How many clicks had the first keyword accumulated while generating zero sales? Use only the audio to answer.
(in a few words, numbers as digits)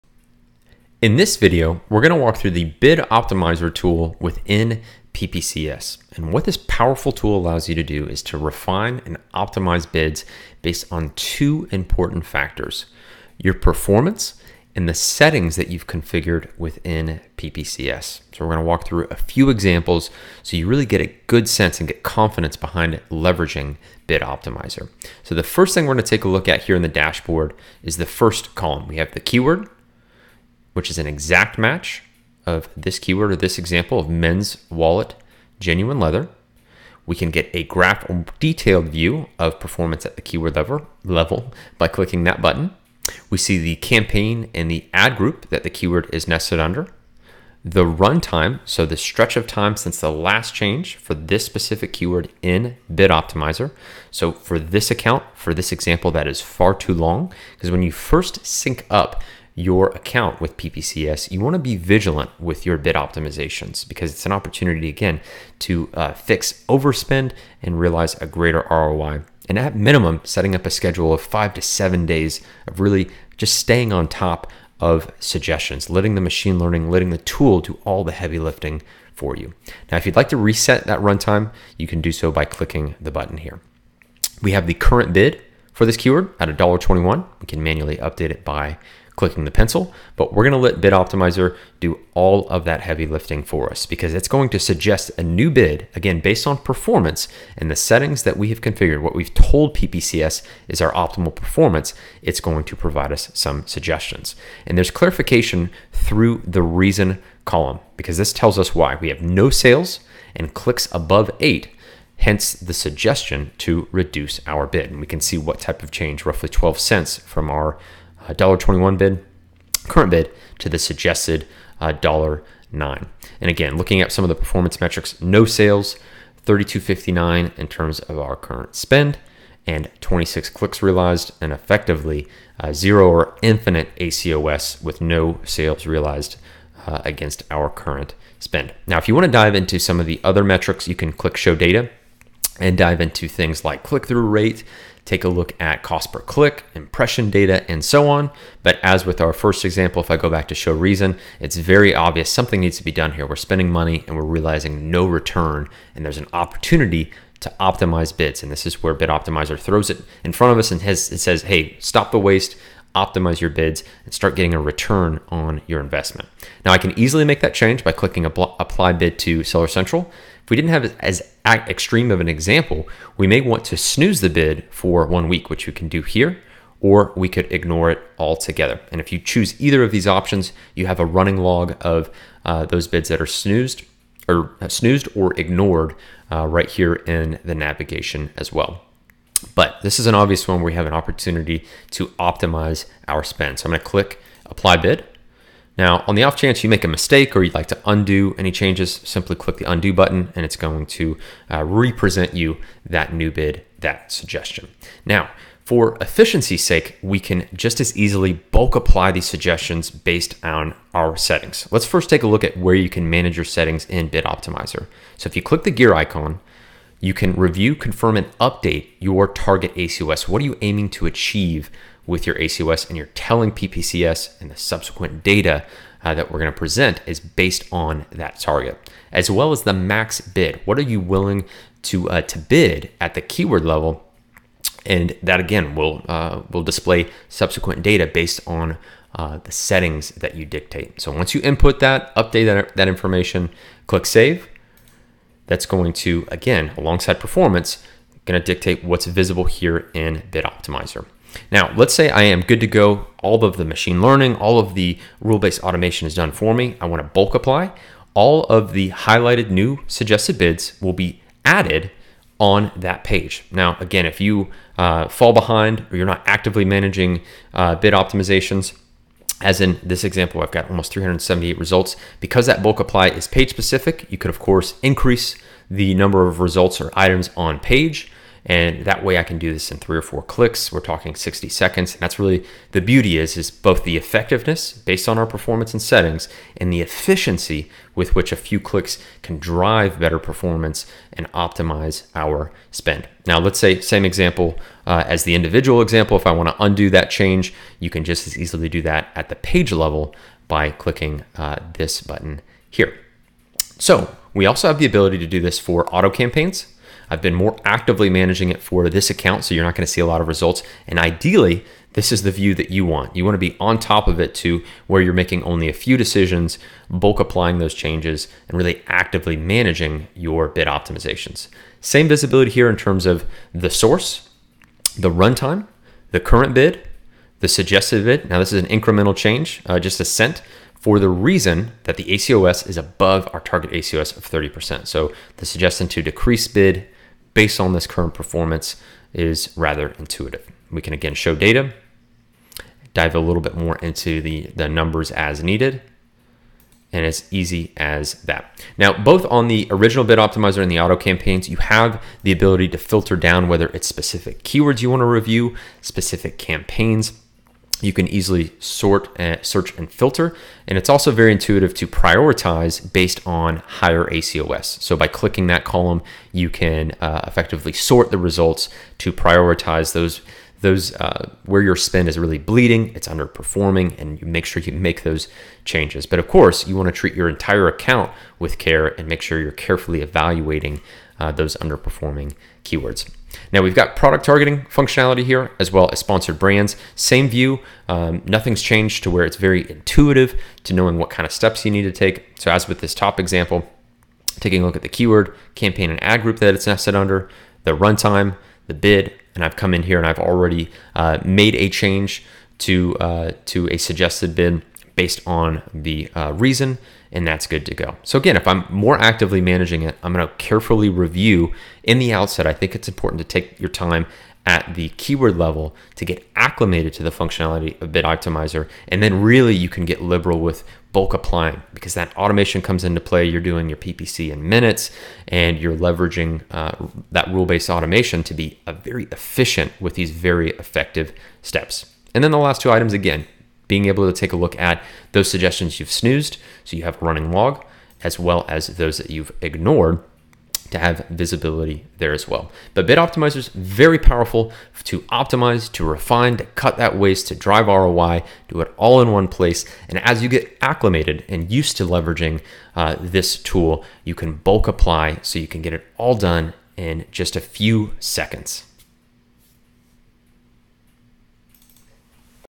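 26.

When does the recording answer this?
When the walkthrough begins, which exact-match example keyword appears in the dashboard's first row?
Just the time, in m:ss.
0:34.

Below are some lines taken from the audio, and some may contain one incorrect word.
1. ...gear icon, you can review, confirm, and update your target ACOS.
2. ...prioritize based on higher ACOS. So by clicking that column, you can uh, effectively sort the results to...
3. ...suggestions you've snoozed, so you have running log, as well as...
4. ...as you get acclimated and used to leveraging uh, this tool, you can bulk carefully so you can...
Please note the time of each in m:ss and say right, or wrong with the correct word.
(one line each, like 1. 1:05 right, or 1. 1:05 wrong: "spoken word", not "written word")
1. 3:35 right
2. 6:01 right
3. 7:15 right
4. 7:30 wrong: "apply", not "carefully".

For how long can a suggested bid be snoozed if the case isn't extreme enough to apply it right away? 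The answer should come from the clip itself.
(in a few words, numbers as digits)
one week.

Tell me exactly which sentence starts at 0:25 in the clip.
So, the first thing we're going to take a look at here in the dashboard is the first column.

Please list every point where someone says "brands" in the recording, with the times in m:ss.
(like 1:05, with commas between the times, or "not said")
6:26.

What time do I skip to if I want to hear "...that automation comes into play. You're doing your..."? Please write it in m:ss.
7:01.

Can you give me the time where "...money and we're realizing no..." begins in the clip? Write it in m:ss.
2:33.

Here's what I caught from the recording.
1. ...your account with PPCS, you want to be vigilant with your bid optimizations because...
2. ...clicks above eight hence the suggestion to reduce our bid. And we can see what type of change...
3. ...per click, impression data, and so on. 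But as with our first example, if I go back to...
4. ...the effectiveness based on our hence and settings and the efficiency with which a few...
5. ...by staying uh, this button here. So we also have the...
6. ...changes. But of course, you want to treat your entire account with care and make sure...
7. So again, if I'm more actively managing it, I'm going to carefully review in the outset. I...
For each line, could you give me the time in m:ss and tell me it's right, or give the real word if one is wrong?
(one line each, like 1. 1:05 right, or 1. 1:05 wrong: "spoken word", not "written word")
1. 0:59 right
2. 1:50 right
3. 2:26 right
4. 4:43 wrong: "performance", not "hence"
5. 5:00 wrong: "clicking", not "staying"
6. 6:15 right
7. 6:48 right.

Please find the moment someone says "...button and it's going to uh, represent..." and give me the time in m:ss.
3:19.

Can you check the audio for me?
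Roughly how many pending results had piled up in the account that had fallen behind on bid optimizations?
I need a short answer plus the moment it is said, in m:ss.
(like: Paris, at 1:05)
378, at 4:30.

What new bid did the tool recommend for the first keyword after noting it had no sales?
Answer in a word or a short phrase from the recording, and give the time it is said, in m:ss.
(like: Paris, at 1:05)
$1.09, at 2:01.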